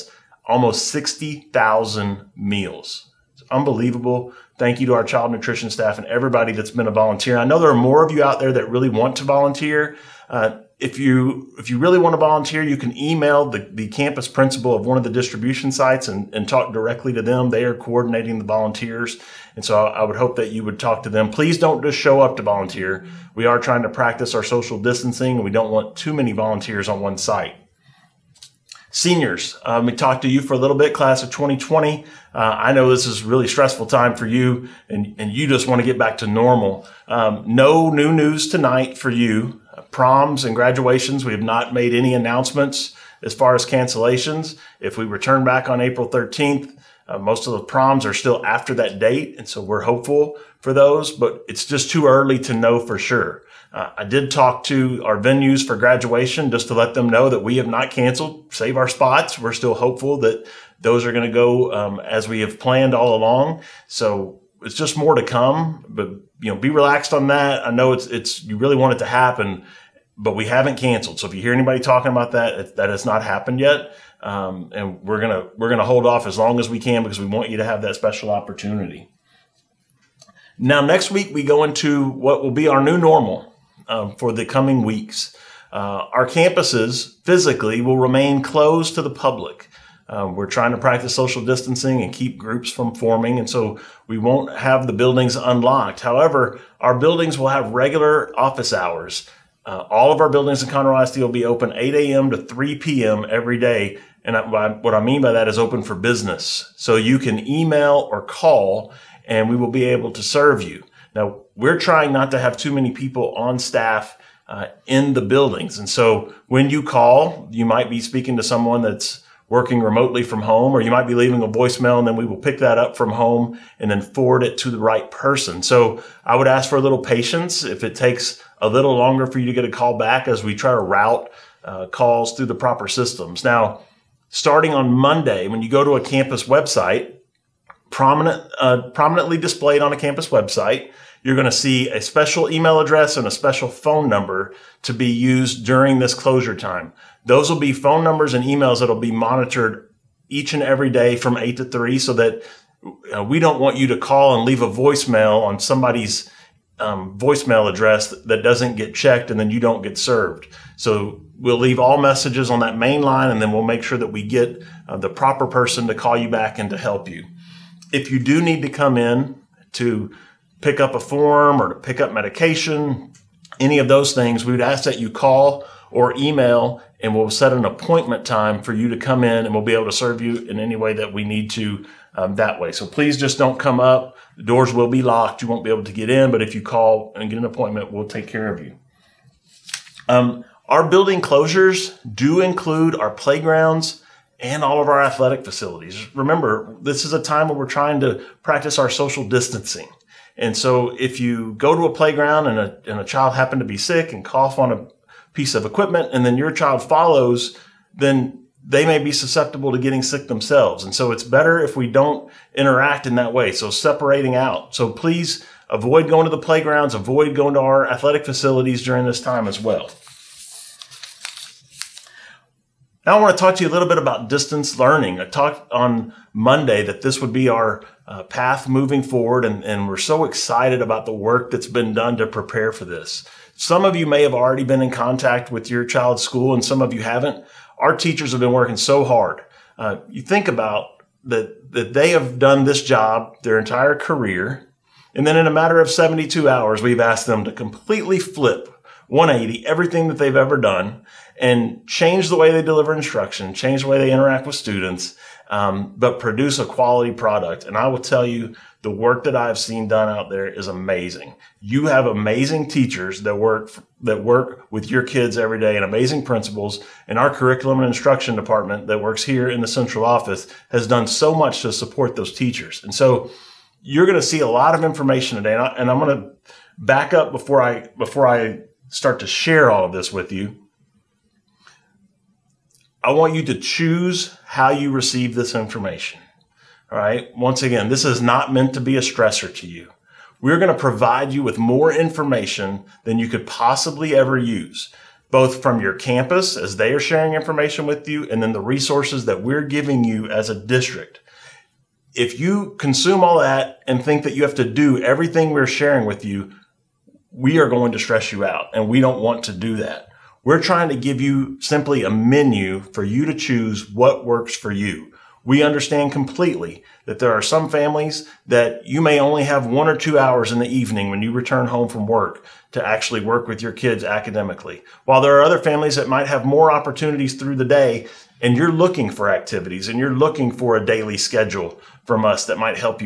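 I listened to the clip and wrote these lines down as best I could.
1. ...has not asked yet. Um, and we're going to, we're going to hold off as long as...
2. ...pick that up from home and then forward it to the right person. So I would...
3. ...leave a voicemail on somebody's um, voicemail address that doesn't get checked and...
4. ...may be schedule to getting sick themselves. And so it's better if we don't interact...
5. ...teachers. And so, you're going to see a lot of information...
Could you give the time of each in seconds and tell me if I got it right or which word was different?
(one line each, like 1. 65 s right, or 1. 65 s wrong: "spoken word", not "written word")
1. 72 s wrong: "happened", not "asked"
2. 122 s right
3. 154 s right
4. 208 s wrong: "susceptible", not "schedule"
5. 272 s right.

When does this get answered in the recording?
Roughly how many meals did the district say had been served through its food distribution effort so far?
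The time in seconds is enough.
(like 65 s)
0 s.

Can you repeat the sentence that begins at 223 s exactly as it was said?
Now I want to talk to you a little bit about distance learning.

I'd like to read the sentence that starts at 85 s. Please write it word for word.
Uh, our campuses physically will remain closed to the public.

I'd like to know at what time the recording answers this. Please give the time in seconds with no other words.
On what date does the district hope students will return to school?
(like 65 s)
45 s.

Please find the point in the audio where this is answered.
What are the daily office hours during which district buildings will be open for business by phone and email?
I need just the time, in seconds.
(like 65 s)
101 s.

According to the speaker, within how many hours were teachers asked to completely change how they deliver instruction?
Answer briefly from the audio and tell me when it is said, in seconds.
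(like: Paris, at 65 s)
72 hours, at 245 s.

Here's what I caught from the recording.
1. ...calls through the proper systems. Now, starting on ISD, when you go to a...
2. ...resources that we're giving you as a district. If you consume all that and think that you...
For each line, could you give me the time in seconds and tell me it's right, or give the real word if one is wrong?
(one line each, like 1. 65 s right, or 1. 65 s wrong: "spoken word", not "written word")
1. 131 s wrong: "Monday", not "ISD"
2. 298 s right.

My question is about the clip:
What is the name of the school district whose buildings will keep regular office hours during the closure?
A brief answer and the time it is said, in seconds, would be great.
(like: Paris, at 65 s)
Conroe ISD, at 100 s.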